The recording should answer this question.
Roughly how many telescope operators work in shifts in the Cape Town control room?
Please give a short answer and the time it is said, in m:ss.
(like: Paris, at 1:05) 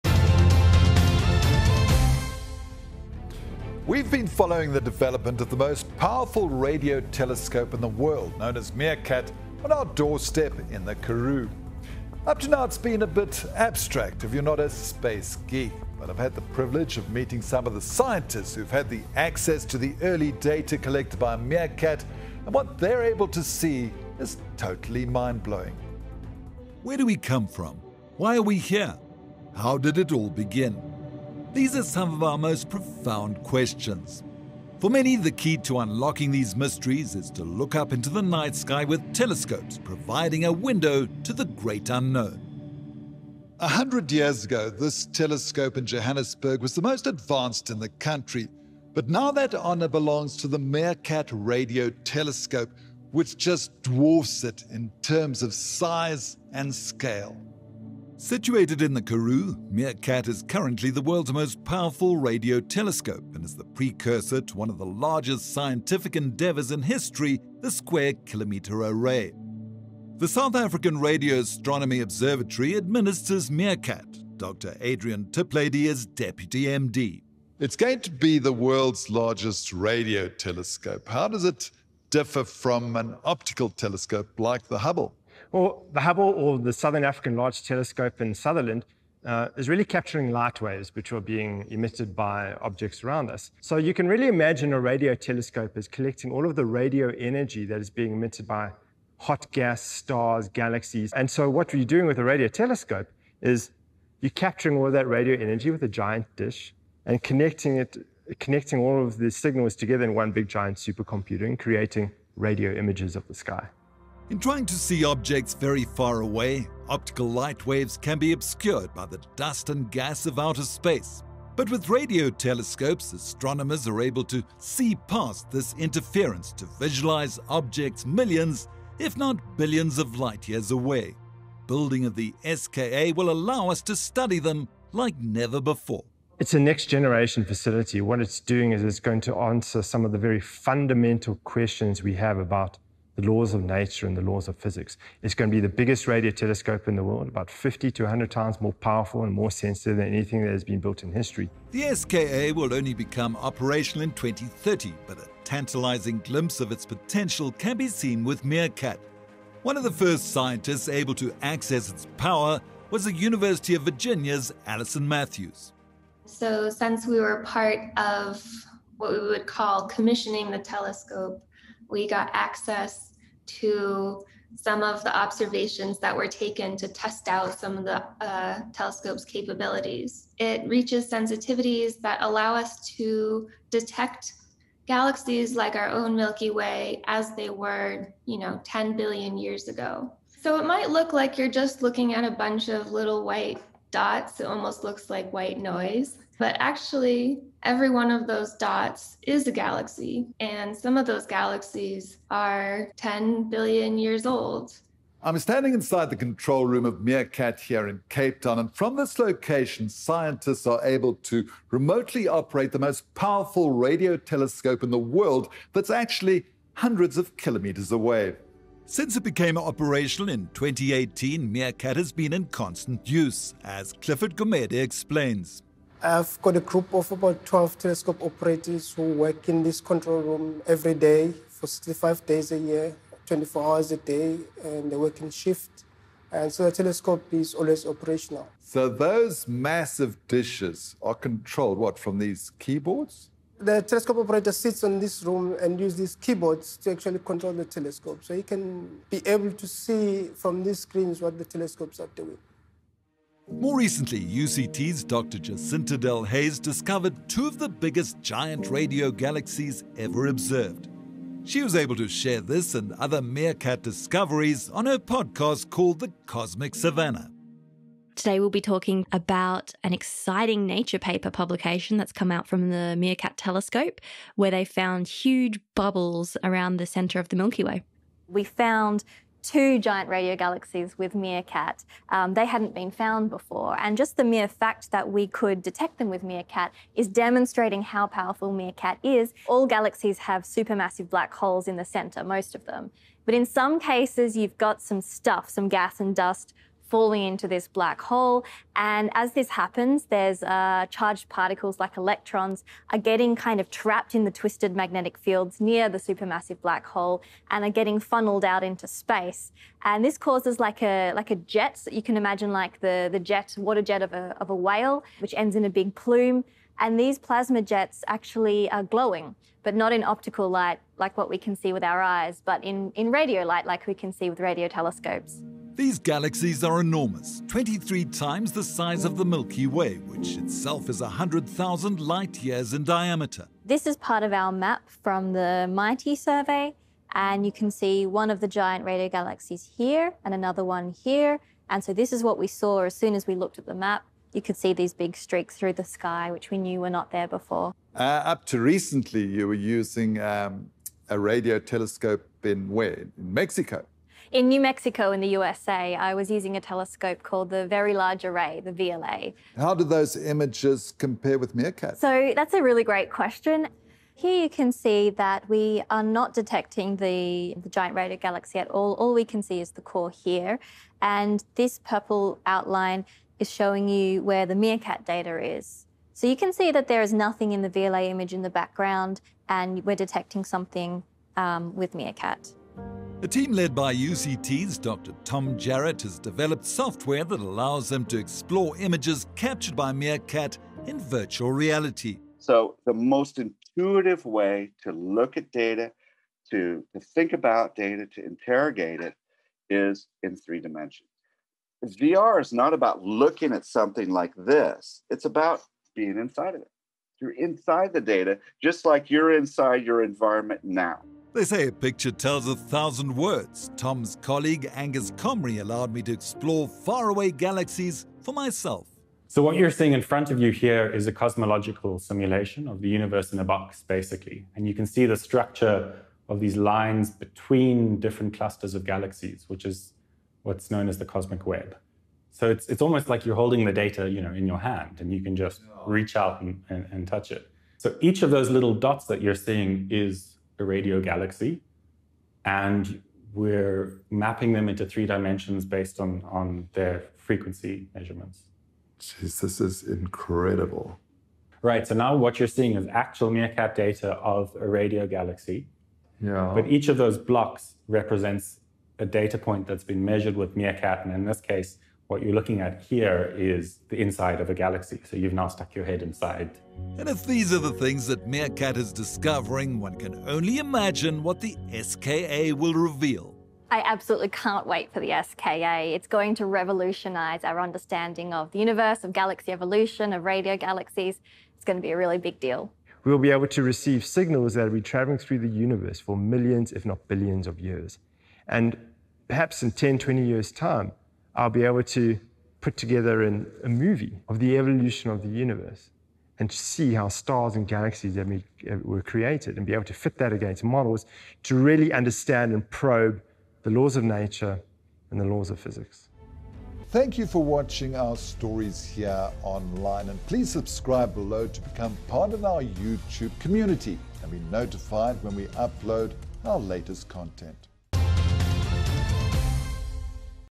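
12, at 3:47.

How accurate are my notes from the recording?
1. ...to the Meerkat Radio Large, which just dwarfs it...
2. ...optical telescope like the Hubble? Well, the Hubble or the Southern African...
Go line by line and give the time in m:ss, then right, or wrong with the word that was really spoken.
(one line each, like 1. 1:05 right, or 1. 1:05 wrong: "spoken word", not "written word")
1. 0:50 wrong: "Telescope", not "Large"
2. 1:23 right.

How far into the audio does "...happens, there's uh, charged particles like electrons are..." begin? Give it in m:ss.
4:59.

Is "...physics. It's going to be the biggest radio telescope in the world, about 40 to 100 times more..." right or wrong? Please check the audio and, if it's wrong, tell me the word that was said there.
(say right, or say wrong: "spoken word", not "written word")
wrong: "50", not "40".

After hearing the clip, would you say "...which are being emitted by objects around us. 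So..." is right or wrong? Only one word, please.
right.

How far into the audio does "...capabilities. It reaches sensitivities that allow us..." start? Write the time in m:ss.
2:59.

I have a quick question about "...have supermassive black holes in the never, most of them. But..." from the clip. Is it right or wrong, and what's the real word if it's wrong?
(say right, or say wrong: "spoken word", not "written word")
wrong: "center", not "never".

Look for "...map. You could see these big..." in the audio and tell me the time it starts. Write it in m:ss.
5:43.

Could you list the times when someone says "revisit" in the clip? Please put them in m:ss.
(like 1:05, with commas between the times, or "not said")
not said.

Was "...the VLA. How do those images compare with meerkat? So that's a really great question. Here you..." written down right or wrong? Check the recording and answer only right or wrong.
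right.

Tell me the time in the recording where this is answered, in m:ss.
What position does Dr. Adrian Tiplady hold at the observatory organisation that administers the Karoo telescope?
1:16.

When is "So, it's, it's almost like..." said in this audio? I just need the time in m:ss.
7:12.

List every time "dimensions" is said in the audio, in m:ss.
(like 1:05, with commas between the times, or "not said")
6:40, 7:25.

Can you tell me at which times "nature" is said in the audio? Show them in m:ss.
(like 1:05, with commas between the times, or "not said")
2:23, 4:30, 8:24.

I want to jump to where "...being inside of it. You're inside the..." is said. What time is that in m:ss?
6:45.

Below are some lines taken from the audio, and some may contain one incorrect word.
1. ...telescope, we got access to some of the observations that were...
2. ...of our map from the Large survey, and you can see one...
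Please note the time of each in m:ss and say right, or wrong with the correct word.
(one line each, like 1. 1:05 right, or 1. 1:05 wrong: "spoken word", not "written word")
1. 2:50 right
2. 5:34 wrong: "MIGHTEE", not "Large".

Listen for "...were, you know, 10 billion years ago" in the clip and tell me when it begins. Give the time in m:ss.
3:07.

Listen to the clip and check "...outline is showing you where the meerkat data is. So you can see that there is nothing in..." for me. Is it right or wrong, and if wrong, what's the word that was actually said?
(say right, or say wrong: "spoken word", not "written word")
right.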